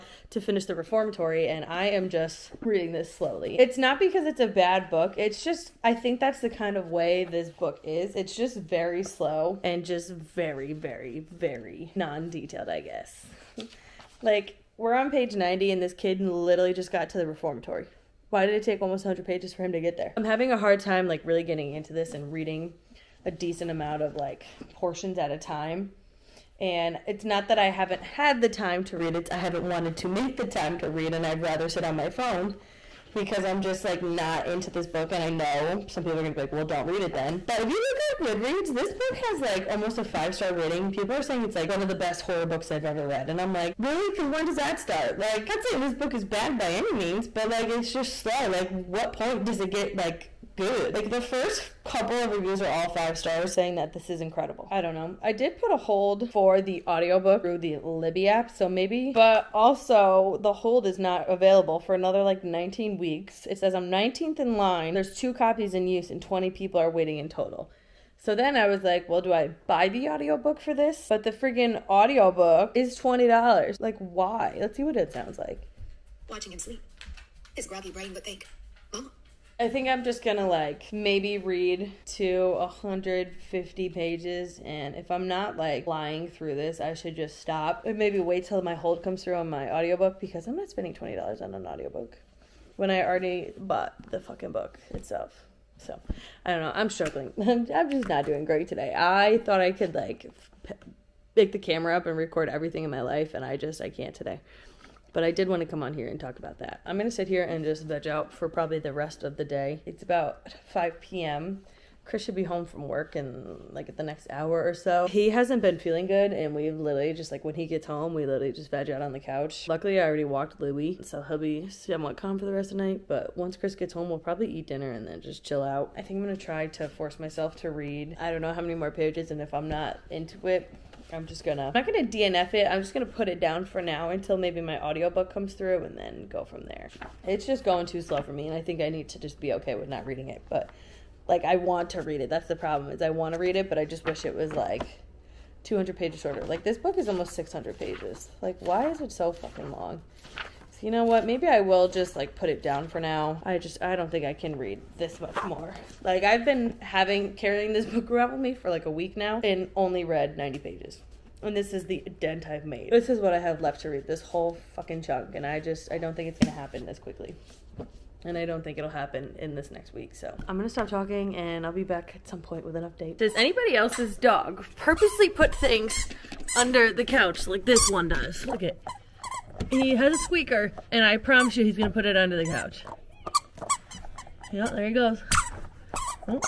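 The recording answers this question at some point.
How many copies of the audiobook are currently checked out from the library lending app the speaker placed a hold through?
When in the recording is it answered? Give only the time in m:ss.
1:05.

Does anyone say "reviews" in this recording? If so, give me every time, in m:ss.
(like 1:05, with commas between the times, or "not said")
0:52.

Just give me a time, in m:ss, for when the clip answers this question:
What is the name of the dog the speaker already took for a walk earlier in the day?
2:00.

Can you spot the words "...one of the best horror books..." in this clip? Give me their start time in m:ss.
0:41.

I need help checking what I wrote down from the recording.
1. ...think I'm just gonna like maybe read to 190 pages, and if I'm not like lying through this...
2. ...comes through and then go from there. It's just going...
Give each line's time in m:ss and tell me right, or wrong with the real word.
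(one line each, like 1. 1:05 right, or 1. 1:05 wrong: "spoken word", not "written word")
1. 1:19 wrong: "150", not "190"
2. 2:15 right.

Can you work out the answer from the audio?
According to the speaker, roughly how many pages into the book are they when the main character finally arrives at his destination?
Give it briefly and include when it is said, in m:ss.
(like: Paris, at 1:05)
90, at 0:15.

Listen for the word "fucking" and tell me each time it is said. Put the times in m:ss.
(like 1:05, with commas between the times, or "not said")
1:34, 2:29, 2:44.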